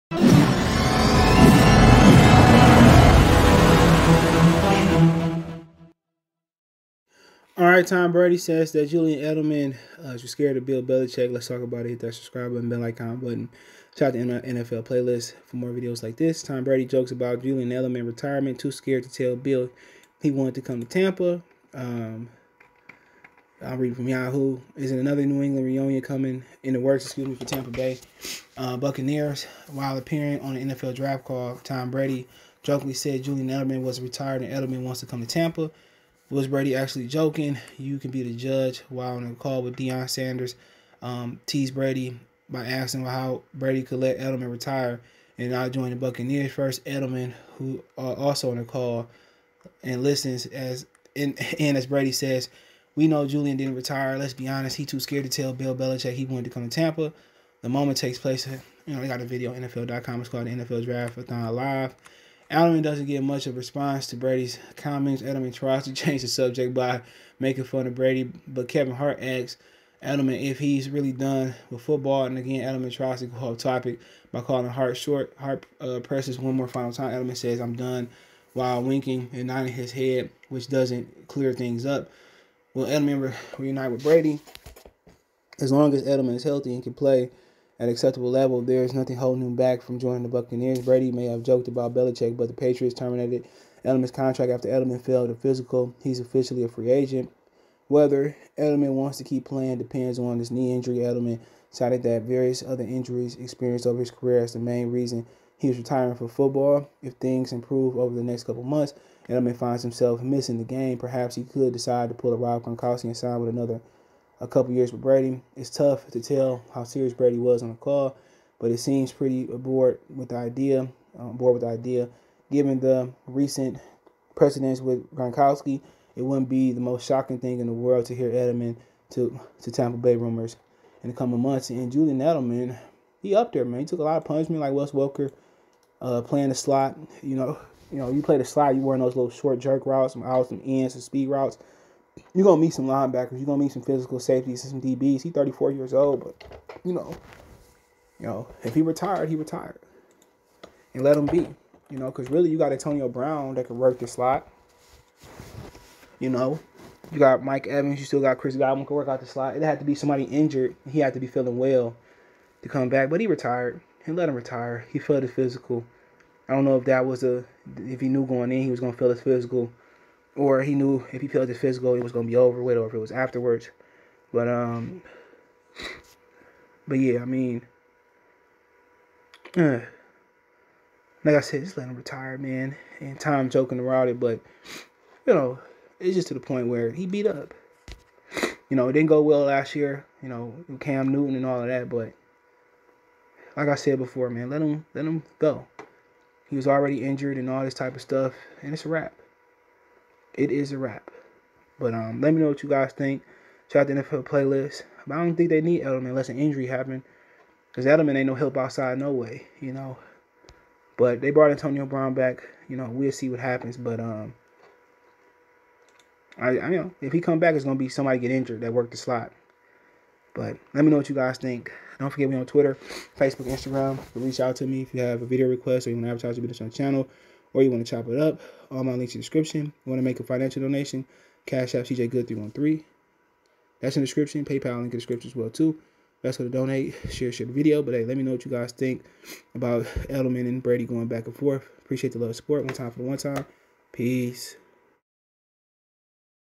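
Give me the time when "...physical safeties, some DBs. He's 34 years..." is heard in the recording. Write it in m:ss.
2:23.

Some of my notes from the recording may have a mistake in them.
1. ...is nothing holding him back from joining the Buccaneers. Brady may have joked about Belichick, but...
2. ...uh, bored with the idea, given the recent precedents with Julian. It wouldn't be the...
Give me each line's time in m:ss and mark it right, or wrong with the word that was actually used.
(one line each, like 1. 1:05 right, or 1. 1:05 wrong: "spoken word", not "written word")
1. 1:28 right
2. 2:01 wrong: "Gronkowski", not "Julian".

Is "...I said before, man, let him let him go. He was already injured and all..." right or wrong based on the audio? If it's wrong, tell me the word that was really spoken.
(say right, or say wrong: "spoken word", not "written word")
right.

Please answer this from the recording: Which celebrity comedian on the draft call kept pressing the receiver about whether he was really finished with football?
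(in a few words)
Kevin Hart.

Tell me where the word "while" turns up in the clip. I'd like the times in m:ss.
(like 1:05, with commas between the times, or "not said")
0:29, 0:38, 1:18.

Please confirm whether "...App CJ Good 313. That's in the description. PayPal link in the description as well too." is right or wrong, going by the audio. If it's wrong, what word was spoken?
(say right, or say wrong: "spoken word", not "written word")
right.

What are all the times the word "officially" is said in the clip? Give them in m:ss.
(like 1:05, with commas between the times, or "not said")
1:36.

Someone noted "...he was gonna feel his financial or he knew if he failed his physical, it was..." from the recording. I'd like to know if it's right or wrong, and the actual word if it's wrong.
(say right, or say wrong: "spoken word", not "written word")
wrong: "physical", not "financial".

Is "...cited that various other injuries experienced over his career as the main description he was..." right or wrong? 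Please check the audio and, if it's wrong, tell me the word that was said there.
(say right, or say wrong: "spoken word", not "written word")
wrong: "reason", not "description".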